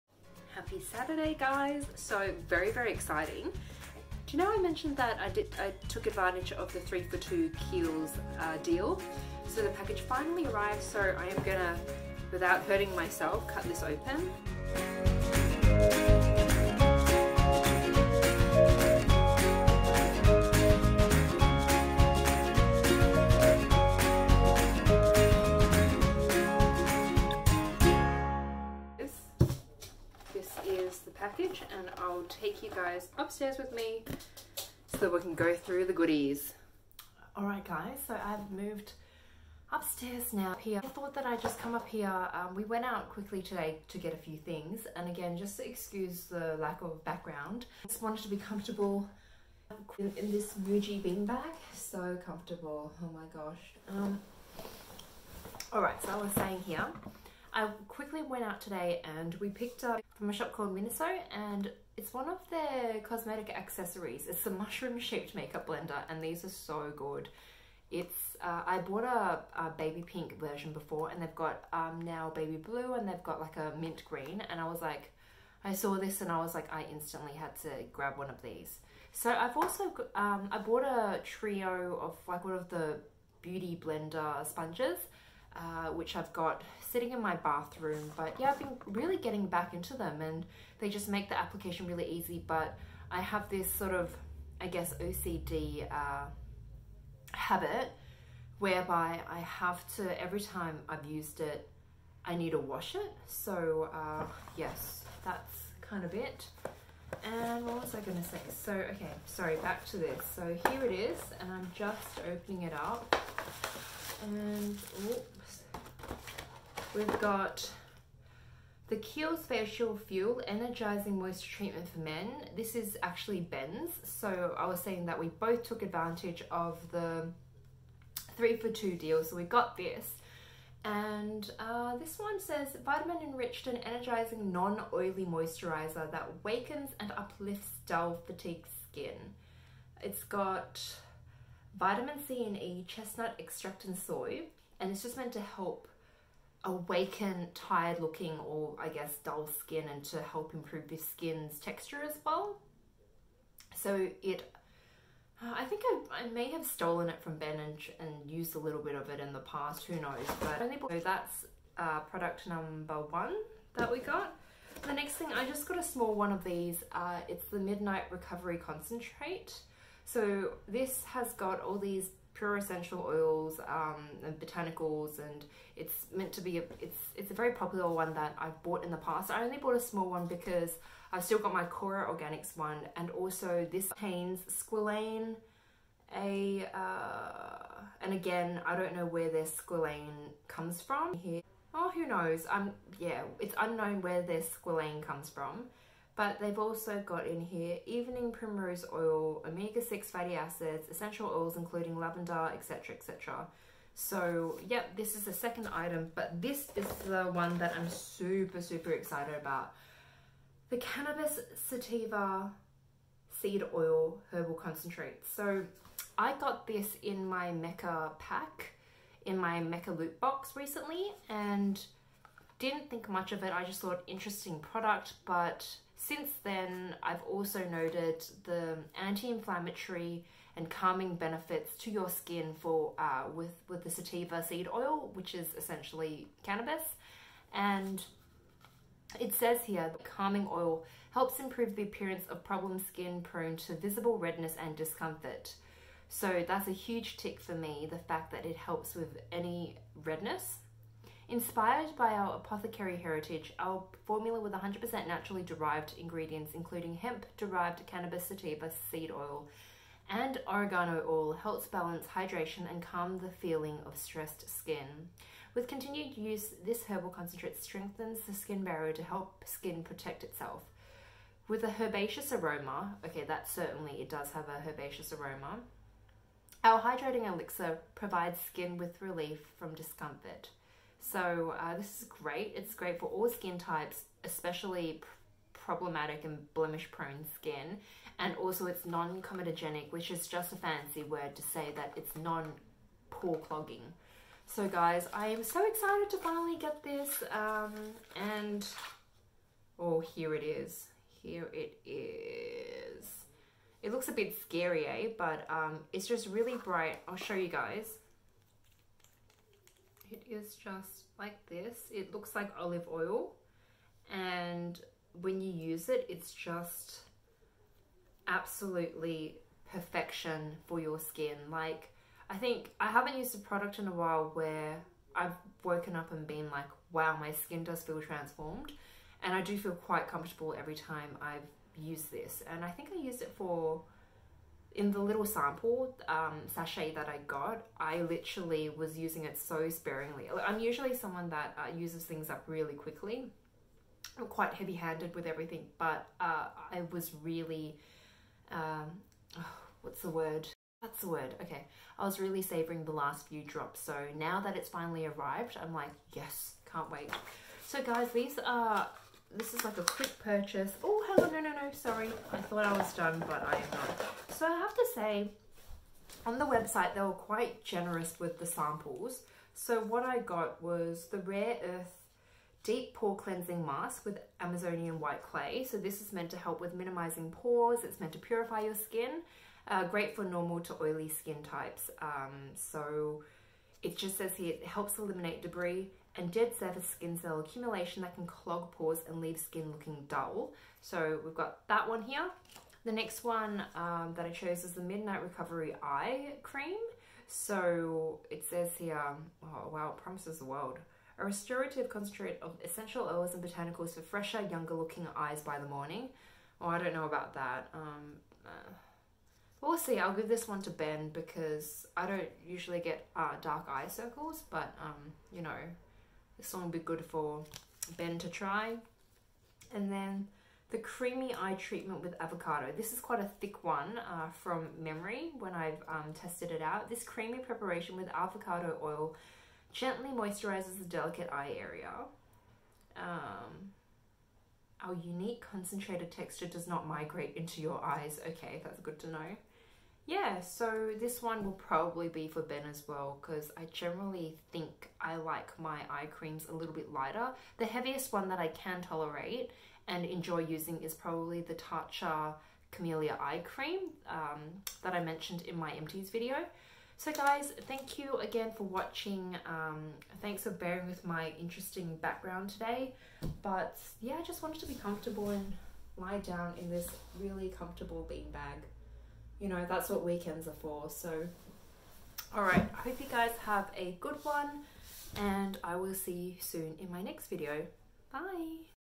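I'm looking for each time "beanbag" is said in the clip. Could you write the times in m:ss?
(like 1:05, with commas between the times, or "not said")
0:51, 7:48.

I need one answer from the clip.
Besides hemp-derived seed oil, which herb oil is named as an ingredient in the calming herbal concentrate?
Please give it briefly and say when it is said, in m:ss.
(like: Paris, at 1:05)
oregano oil, at 4:20.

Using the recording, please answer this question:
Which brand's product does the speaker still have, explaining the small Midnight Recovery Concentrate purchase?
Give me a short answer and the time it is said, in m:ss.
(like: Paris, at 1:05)
Kora Organics, at 3:01.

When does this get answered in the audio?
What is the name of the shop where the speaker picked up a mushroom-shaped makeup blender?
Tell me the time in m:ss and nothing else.
1:00.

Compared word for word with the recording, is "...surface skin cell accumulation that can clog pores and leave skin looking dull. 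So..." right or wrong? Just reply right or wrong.
right.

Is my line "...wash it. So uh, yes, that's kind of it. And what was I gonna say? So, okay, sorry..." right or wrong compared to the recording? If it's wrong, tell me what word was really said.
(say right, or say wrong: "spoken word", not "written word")
right.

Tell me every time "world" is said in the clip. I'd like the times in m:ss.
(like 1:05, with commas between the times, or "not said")
6:40.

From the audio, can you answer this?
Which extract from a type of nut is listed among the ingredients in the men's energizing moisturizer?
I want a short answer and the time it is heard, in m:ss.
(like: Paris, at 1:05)
chestnut extract, at 2:22.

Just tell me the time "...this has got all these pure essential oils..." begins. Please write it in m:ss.
2:50.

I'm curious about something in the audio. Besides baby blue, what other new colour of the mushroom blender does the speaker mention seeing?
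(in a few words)
mint green.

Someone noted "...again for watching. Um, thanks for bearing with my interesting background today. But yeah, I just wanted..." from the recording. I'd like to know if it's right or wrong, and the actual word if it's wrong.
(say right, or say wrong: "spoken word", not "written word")
right.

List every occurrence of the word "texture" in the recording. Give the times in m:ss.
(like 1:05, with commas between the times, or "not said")
2:31, 7:16.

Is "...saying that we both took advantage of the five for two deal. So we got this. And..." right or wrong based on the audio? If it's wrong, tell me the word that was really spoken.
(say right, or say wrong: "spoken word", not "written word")
wrong: "three", not "five".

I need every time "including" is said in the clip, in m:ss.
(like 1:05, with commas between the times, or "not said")
3:21, 4:16.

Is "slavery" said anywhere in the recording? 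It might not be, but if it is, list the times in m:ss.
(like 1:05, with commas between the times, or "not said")
not said.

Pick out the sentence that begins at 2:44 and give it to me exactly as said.
The next thing, I just got a small one of these.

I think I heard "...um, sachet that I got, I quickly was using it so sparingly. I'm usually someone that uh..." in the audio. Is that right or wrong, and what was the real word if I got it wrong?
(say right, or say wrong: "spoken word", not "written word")
wrong: "literally", not "quickly".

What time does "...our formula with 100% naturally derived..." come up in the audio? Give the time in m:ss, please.
4:13.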